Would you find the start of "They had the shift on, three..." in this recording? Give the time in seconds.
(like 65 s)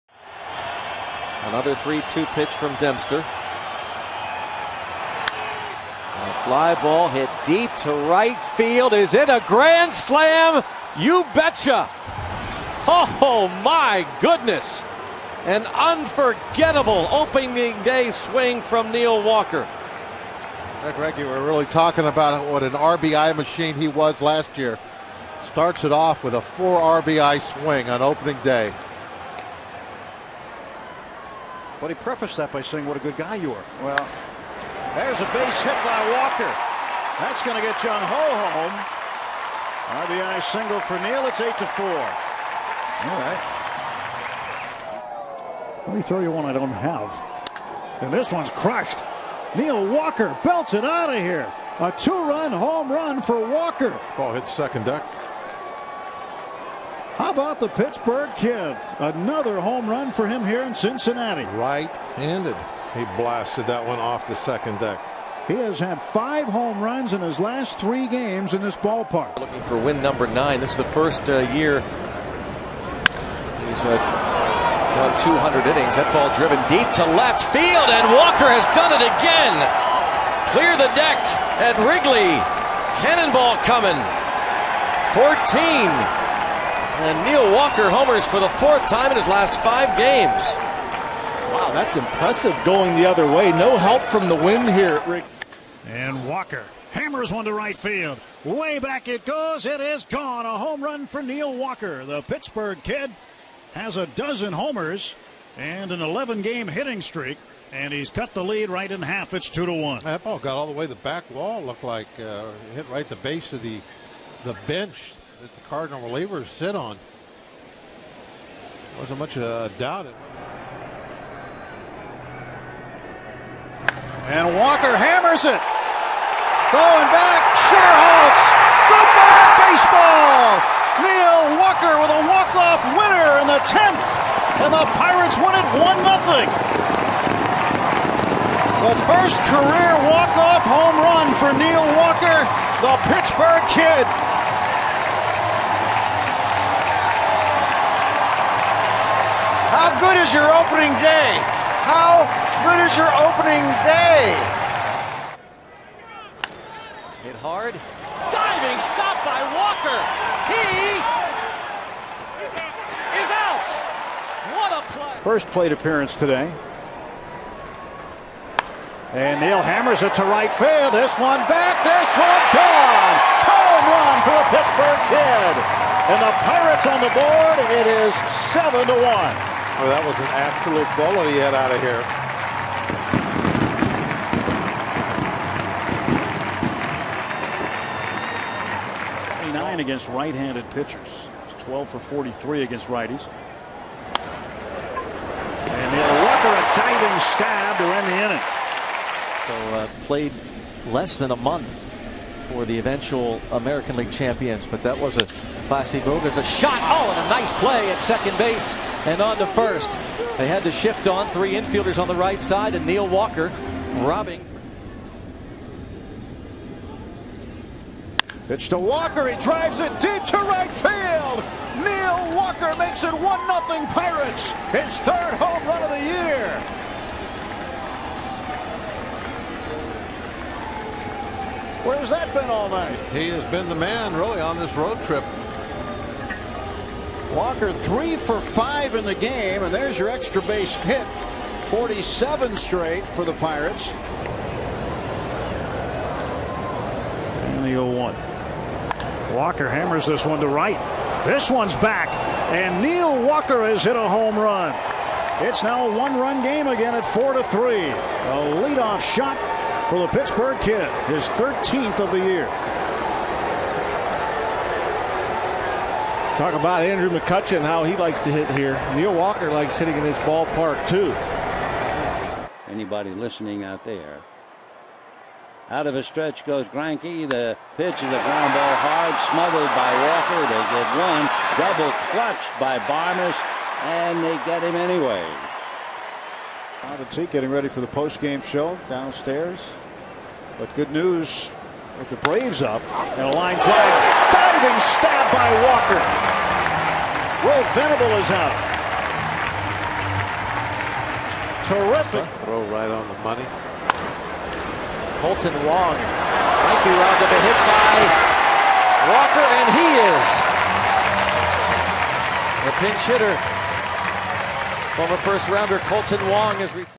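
210 s.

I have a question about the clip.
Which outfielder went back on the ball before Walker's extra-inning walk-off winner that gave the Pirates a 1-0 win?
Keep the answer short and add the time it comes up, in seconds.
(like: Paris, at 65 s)
Schierholtz, at 127 s.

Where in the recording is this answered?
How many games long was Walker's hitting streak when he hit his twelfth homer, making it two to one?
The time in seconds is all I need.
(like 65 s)
106 s.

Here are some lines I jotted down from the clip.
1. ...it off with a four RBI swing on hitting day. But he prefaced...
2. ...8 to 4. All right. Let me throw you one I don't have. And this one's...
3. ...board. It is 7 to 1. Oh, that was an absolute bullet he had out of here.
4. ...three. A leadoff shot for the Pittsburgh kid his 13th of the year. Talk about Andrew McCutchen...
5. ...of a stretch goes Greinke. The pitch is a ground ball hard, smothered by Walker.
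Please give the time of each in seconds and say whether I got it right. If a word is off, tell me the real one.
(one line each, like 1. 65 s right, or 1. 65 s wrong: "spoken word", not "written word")
1. 25 s wrong: "opening", not "hitting"
2. 41 s right
3. 177 s right
4. 257 s right
5. 275 s right.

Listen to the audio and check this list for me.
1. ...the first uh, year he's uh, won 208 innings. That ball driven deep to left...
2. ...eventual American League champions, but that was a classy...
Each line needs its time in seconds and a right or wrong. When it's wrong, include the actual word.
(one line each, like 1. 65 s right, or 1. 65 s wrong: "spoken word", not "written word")
1. 70 s wrong: "200", not "208"
2. 202 s right.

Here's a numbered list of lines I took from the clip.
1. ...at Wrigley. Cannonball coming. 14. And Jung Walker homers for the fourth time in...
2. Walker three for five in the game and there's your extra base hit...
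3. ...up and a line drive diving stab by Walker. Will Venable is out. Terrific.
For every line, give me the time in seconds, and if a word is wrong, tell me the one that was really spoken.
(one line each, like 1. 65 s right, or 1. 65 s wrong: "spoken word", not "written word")
1. 81 s wrong: "Neil", not "Jung"
2. 237 s right
3. 292 s right.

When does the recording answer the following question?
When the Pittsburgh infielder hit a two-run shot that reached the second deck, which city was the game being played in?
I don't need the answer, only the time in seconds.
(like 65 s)
60 s.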